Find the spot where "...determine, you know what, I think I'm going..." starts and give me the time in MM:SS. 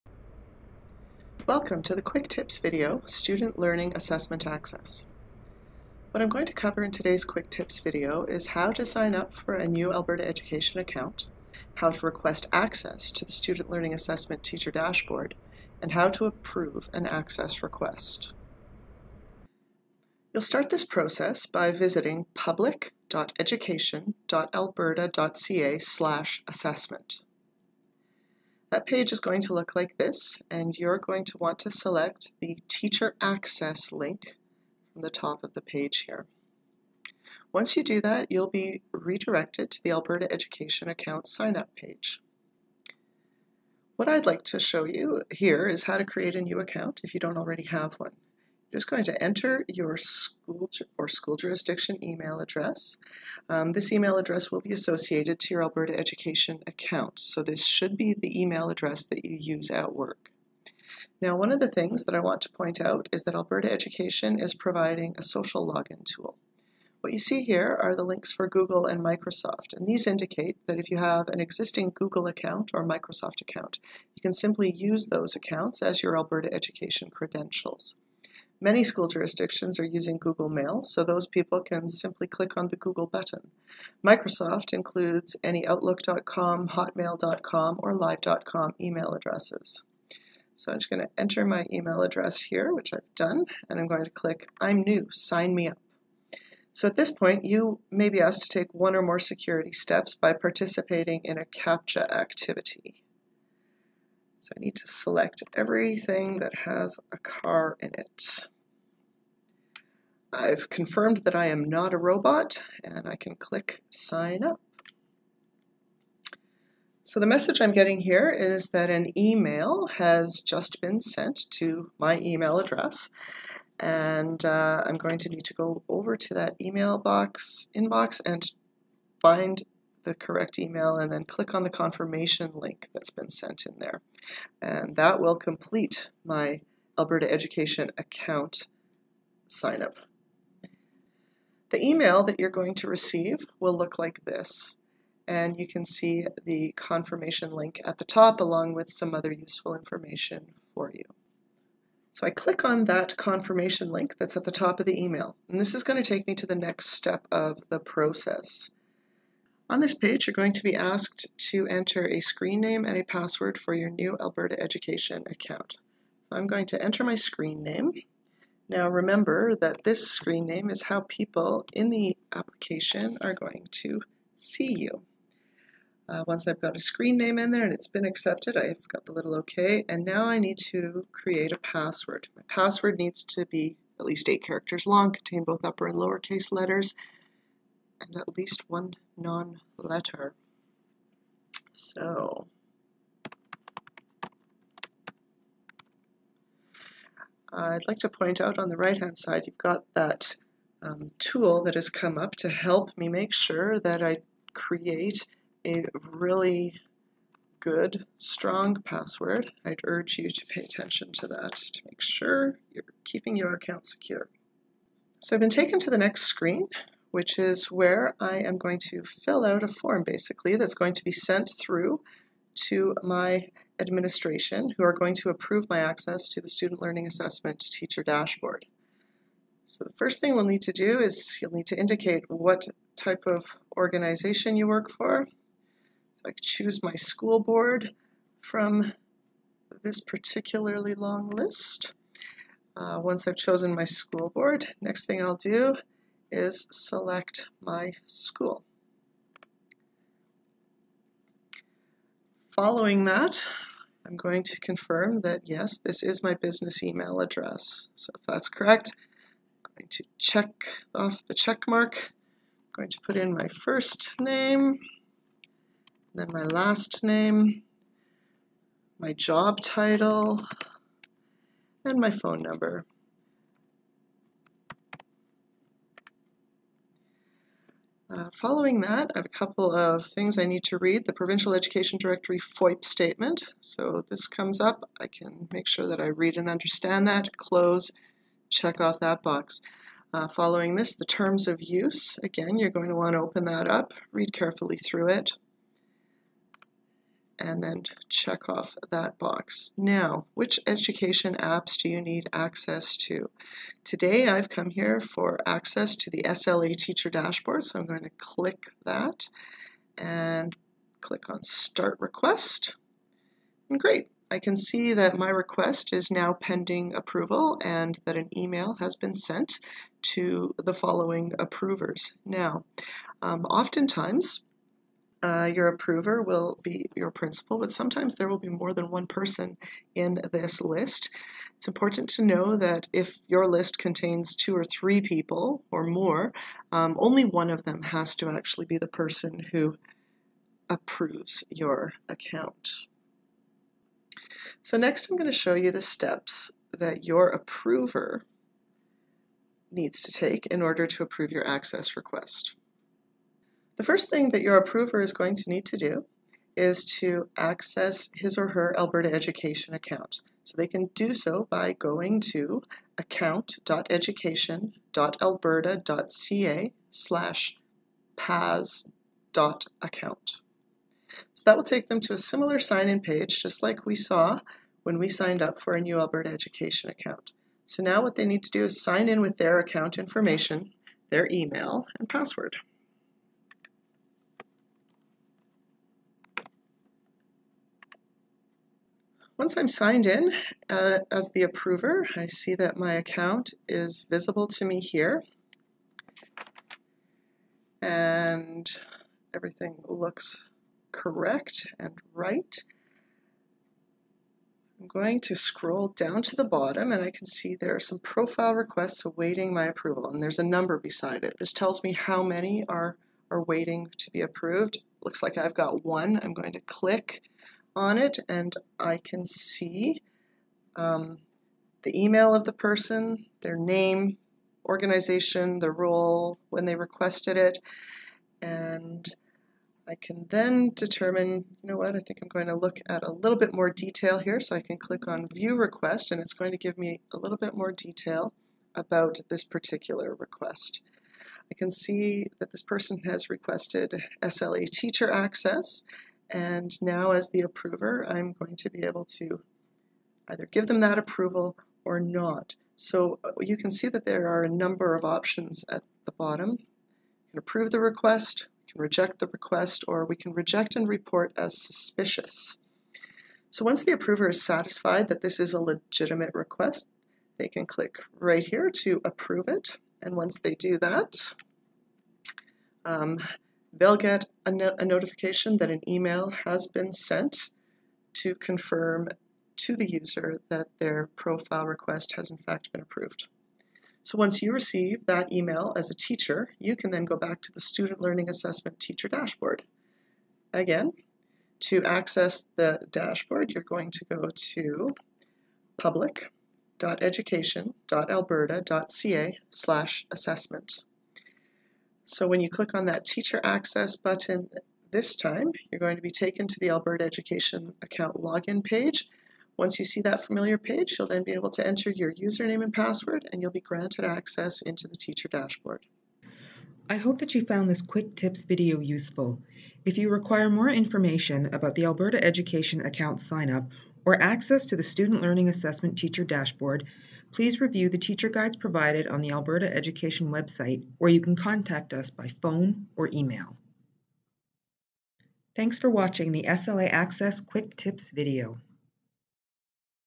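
07:10.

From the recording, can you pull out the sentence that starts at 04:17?
So if that's correct, I'm going to check off the check mark.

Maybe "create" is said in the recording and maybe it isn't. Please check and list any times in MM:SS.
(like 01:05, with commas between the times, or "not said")
00:46, 03:01, 03:24.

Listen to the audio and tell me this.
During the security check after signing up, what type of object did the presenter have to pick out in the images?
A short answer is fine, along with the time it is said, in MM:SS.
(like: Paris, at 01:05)
car, at 01:47.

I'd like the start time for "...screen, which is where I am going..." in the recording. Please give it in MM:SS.
03:36.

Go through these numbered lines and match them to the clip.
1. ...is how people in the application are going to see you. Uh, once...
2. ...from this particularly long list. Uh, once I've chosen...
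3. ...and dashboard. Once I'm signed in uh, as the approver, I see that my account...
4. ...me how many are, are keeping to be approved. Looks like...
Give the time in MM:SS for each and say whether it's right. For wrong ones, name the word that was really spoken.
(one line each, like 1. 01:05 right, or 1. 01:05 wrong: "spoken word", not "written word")
1. 02:50 right
2. 03:58 right
3. 06:21 wrong: "password", not "dashboard"
4. 06:51 wrong: "waiting", not "keeping".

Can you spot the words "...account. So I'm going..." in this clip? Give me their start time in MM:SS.
02:45.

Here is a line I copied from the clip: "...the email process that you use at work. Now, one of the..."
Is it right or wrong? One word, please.
wrong.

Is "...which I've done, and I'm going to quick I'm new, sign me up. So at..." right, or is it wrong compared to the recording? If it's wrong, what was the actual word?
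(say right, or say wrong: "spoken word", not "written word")
wrong: "click", not "quick".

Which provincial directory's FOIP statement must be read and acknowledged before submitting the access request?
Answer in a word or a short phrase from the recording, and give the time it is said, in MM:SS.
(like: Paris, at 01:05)
Provincial Education Directory, at 04:41.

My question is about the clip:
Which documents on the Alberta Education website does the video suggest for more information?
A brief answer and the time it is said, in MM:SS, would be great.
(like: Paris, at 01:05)
teacher guides, at 08:47.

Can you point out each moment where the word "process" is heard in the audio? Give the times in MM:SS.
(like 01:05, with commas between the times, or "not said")
00:20, 02:37.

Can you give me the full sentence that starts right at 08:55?
Thanks for watching the SLA Access Quick Tips video.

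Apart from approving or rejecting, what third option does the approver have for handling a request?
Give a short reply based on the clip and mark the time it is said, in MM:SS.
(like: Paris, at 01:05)
reject and report as suspicious, at 07:40.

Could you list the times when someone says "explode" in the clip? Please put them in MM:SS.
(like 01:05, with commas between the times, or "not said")
not said.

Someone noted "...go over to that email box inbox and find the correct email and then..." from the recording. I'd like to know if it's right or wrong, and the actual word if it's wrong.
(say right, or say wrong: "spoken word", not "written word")
right.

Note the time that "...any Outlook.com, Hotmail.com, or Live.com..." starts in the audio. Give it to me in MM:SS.
01:25.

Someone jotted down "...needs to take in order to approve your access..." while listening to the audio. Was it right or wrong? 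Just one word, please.
right.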